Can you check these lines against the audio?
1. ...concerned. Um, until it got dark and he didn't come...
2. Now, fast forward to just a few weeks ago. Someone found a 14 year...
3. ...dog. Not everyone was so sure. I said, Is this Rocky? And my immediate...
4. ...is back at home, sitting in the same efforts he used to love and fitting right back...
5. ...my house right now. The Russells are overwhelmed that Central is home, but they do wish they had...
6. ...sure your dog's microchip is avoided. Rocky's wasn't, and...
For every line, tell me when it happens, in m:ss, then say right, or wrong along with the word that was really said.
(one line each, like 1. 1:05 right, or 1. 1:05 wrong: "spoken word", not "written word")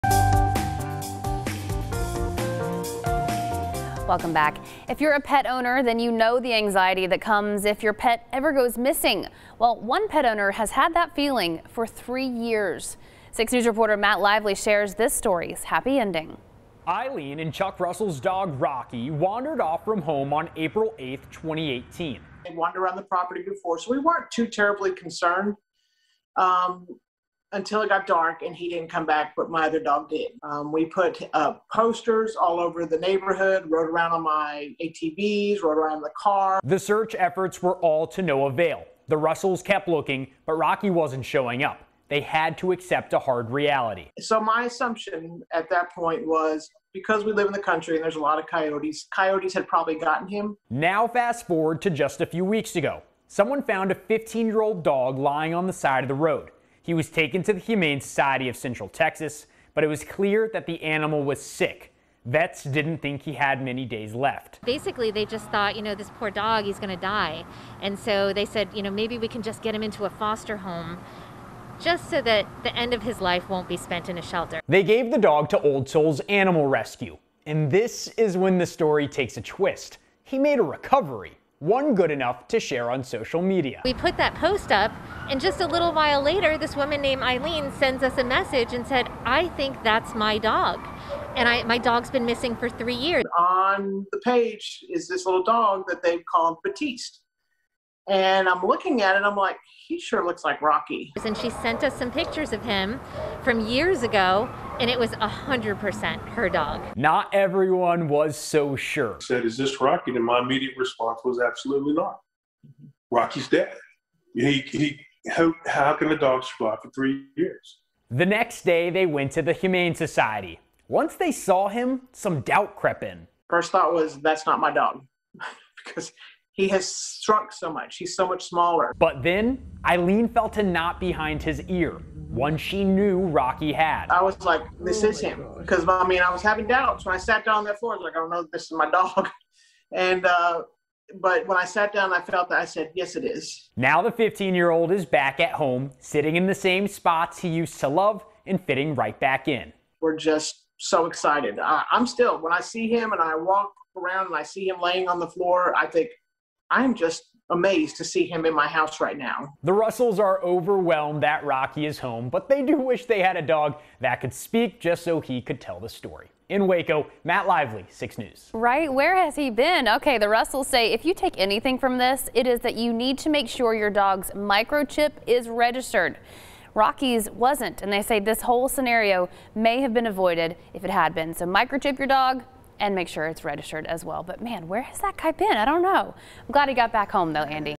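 1. 0:24 right
2. 0:50 wrong: "15", not "14"
3. 1:46 right
4. 2:24 wrong: "spots", not "efforts"
5. 2:38 wrong: "Rocky", not "Central"
6. 2:53 wrong: "registered", not "avoided".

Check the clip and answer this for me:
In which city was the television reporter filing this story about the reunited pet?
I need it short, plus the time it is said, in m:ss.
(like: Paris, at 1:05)
Waco, at 2:46.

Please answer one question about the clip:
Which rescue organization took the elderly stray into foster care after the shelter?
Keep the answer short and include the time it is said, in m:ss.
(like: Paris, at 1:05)
Old Soul's Animal Rescue, at 1:15.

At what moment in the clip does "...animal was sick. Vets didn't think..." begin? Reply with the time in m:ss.
1:00.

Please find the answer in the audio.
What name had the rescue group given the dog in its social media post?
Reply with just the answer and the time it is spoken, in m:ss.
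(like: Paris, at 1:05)
Batiste, at 1:36.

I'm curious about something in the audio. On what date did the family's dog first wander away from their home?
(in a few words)
April 8th, 2018.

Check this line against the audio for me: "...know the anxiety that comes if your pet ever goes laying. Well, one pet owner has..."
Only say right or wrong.
wrong.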